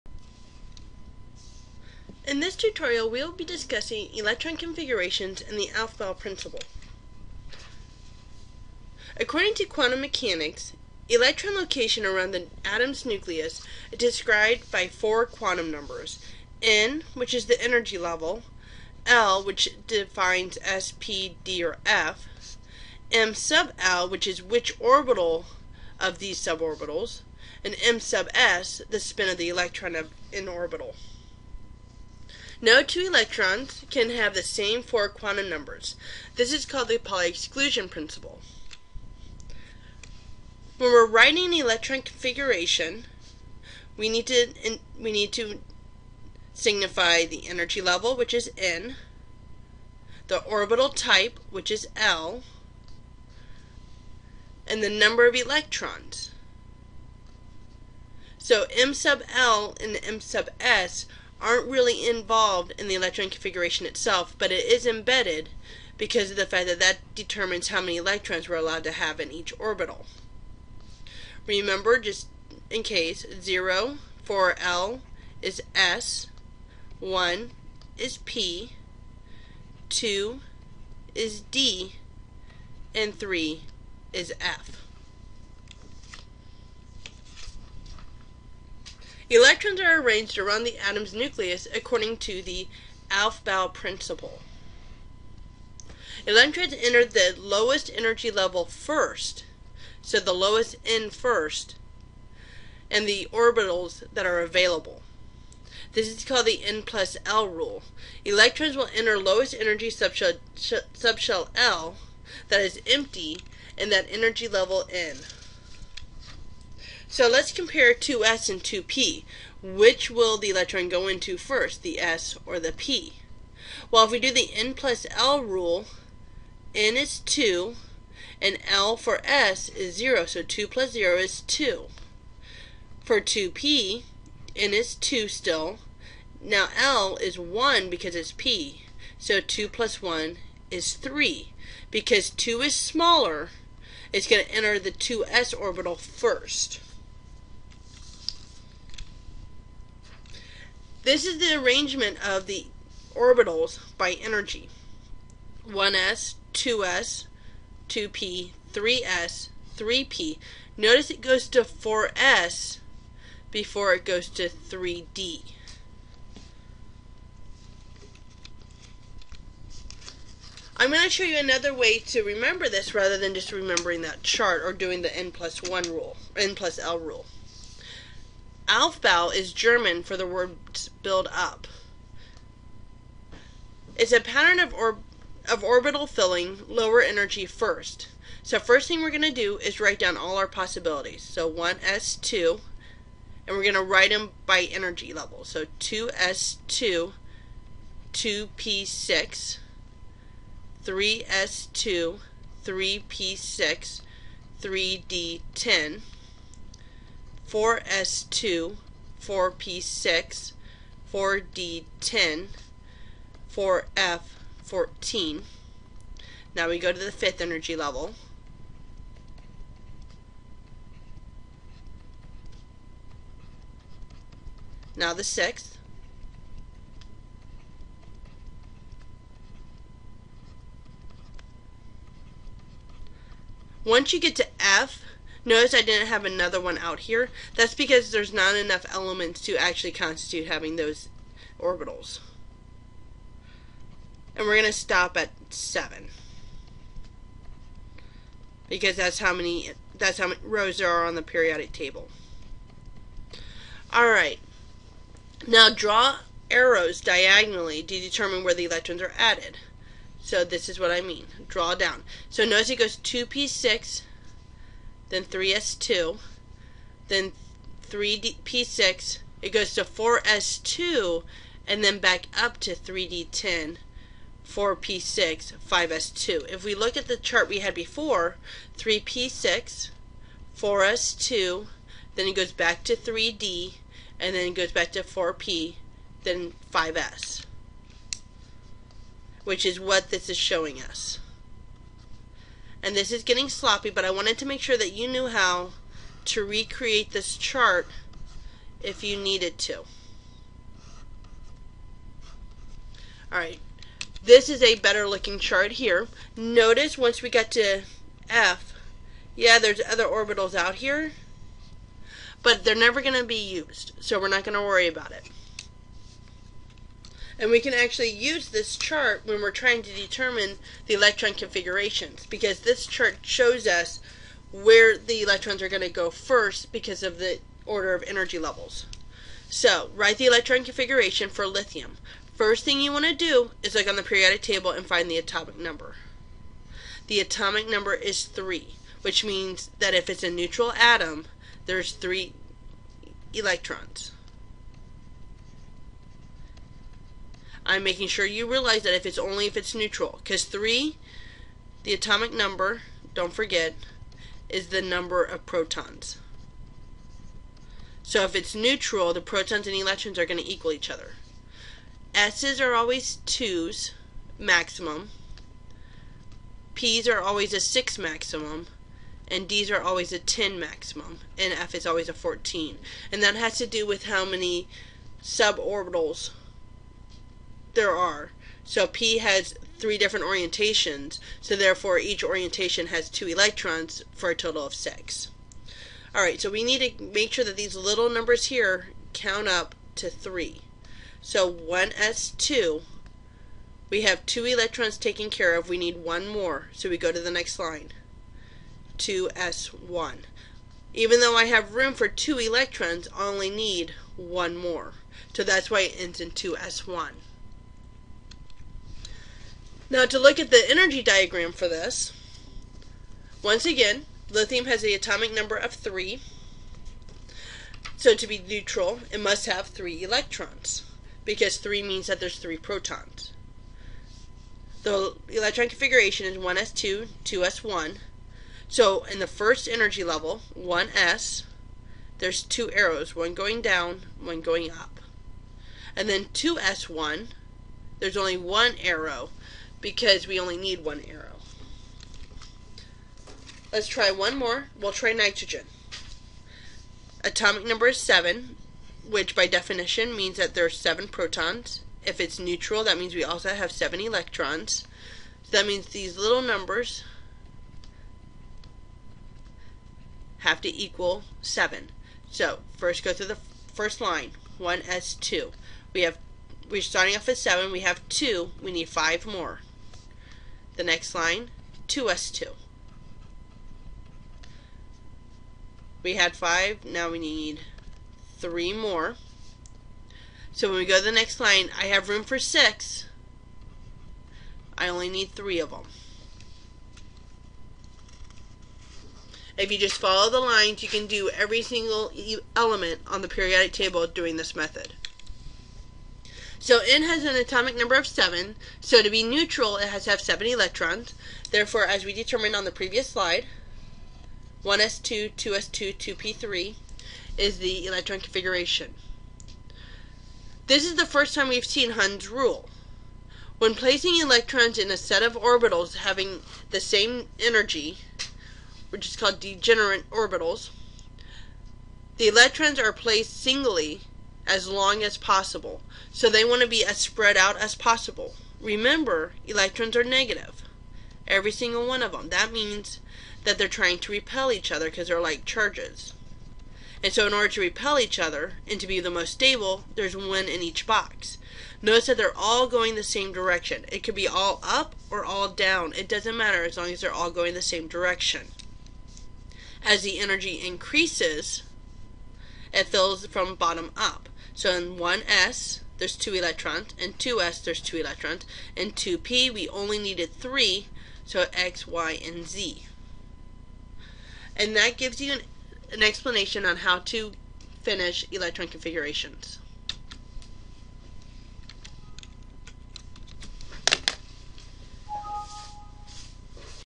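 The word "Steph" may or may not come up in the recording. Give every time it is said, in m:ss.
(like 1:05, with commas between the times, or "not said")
not said.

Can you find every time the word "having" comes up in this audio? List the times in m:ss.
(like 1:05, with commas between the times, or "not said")
4:00, 8:35.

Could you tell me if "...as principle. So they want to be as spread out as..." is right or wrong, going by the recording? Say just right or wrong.
wrong.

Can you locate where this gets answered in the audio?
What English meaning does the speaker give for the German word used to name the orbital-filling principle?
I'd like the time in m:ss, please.
3:01.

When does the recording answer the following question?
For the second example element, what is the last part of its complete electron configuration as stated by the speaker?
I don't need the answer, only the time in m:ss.
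8:25.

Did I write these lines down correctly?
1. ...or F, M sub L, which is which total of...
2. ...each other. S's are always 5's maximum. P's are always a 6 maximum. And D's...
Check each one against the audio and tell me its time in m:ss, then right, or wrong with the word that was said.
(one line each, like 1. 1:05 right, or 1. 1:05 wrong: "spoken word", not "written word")
1. 0:21 wrong: "orbital", not "total"
2. 6:00 wrong: "2", not "5".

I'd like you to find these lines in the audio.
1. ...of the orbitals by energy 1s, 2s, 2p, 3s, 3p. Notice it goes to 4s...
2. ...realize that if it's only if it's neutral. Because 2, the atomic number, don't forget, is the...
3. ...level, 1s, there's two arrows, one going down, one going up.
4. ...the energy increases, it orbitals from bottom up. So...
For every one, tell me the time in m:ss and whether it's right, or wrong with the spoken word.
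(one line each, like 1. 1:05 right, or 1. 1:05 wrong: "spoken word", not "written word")
1. 2:32 right
2. 5:48 wrong: "3", not "2"
3. 7:10 right
4. 9:10 wrong: "fills", not "orbitals".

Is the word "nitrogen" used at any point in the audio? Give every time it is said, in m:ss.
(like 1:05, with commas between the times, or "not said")
7:25.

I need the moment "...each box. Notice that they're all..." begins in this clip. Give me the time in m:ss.
9:00.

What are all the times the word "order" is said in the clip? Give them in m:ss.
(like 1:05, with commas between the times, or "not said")
5:27, 8:57.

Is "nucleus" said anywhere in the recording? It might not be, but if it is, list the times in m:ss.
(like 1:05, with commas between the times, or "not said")
0:13, 1:31.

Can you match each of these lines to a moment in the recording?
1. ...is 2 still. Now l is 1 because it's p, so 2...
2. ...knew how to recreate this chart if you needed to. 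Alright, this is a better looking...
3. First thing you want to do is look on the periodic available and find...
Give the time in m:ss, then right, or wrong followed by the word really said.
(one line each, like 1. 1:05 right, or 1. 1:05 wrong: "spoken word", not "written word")
1. 2:14 right
2. 4:55 right
3. 5:32 wrong: "table", not "available".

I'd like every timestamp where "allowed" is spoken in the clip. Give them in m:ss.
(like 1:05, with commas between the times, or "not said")
1:08.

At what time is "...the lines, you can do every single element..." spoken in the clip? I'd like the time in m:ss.
8:10.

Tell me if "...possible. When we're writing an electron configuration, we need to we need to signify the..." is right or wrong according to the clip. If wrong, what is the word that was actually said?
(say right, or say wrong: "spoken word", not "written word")
wrong: "principle", not "possible".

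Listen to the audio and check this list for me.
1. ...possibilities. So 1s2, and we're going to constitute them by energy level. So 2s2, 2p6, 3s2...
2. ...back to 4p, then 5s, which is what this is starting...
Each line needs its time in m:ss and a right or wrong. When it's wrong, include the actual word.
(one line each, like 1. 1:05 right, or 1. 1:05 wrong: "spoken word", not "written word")
1. 3:10 wrong: "write", not "constitute"
2. 4:44 wrong: "showing", not "starting".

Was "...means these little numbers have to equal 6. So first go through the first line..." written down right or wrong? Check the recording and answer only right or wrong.
wrong.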